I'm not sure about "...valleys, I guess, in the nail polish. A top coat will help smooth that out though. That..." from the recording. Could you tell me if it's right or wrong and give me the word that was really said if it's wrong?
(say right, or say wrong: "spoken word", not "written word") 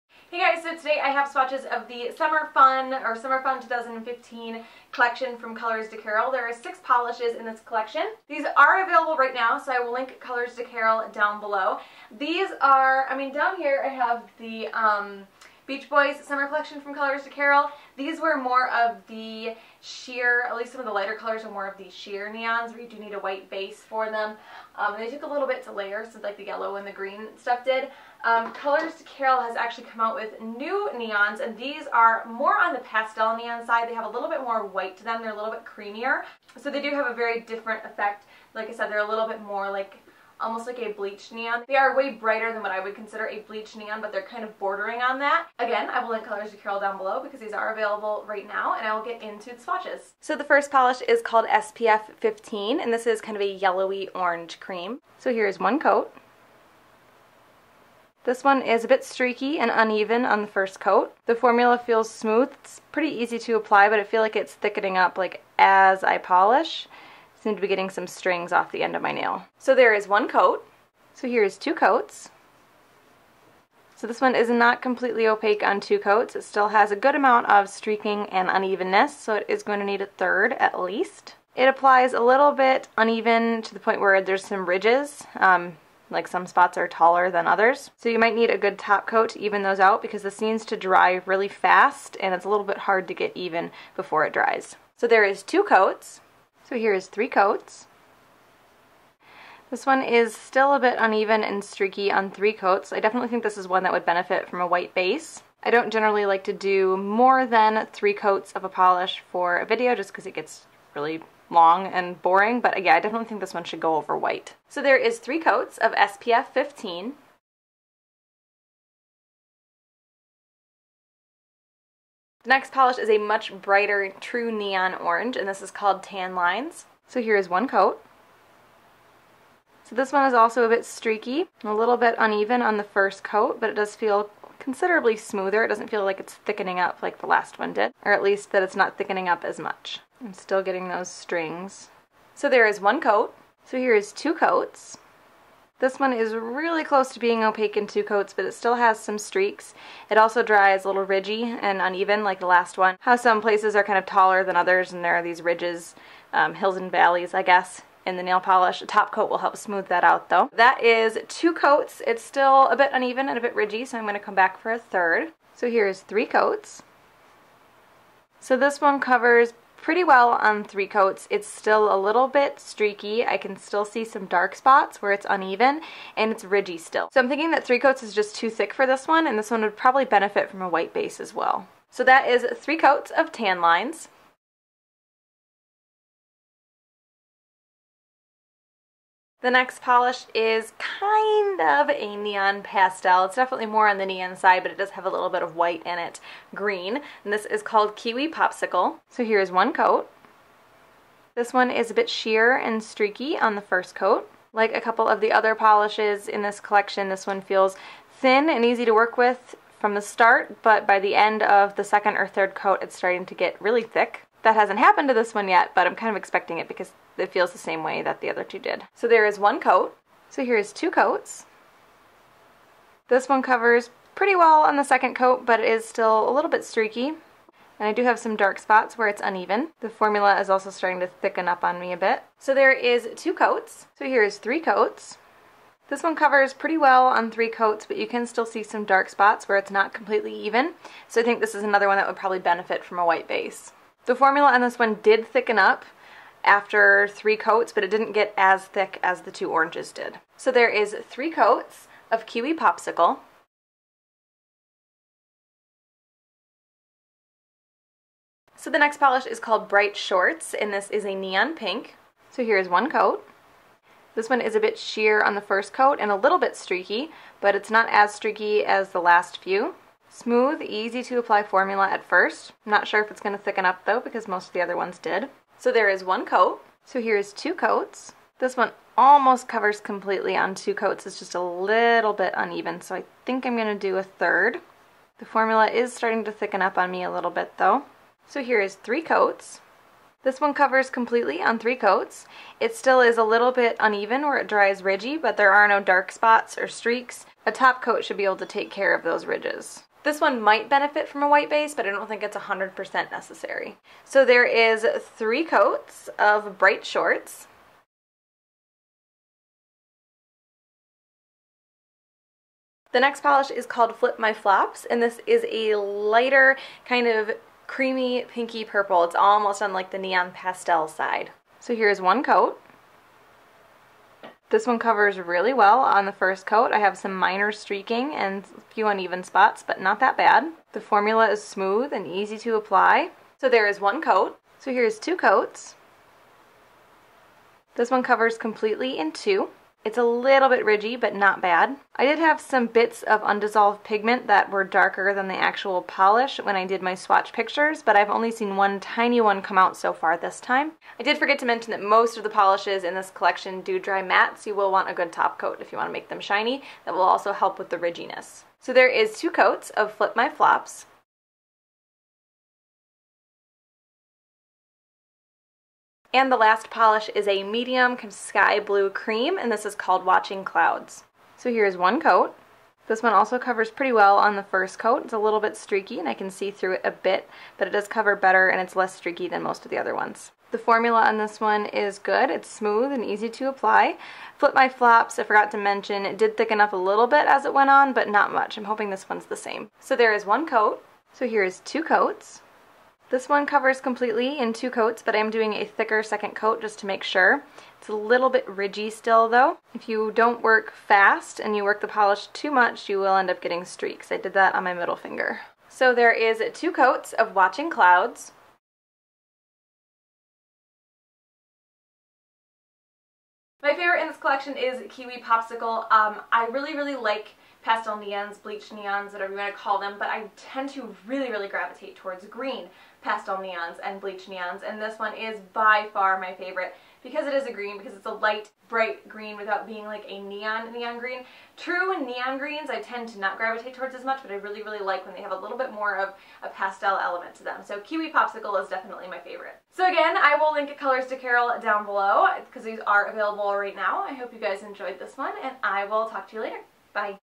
right.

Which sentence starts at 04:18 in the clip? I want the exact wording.
So the next polish is called Bright Shorts, and this is a neon pink.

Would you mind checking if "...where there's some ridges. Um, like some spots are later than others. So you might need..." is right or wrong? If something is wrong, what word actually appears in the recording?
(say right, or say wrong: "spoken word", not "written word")
wrong: "taller", not "later".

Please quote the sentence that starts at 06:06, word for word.
And the last polish is a medium sky blue cream, and this is called Watching Clouds.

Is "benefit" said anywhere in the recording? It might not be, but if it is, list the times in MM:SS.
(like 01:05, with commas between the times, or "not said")
01:44, 03:00, 04:02, 05:00.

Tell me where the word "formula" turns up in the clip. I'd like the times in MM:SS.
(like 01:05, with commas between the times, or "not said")
01:01, 03:49, 04:04, 04:31, 04:45, 05:30, 06:20.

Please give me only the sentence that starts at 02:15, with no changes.
It doesn't feel like it's thickening up like the last one did, or at least that it's not thickening up as much.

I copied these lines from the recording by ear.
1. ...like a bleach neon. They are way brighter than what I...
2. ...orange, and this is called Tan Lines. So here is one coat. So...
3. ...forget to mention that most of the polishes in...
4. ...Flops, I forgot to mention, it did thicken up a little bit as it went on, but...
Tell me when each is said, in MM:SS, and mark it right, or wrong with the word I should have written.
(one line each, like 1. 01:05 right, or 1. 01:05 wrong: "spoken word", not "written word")
1. 00:40 right
2. 02:04 right
3. 05:51 right
4. 06:24 right.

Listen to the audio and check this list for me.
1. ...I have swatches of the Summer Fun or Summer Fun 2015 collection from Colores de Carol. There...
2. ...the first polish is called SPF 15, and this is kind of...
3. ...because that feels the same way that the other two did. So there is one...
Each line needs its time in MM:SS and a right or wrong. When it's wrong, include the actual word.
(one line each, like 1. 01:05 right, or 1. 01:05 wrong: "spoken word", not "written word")
1. 00:01 right
2. 00:50 right
3. 03:36 right.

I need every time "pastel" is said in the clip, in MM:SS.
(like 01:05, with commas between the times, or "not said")
00:32, 03:12, 05:20, 06:57, 07:03, 07:16.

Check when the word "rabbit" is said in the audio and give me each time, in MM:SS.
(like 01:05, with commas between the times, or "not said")
not said.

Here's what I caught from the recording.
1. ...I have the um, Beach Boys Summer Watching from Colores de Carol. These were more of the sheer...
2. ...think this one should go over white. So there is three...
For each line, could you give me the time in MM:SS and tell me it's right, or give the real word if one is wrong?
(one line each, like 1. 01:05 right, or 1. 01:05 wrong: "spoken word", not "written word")
1. 00:13 wrong: "Collection", not "Watching"
2. 01:53 right.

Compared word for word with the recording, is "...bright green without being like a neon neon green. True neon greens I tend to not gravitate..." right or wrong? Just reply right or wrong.
right.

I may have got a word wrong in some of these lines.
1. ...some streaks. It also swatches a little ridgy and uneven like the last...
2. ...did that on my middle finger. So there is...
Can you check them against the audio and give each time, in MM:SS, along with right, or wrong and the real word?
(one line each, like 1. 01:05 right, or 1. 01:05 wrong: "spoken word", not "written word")
1. 02:28 wrong: "dries", not "swatches"
2. 06:44 right.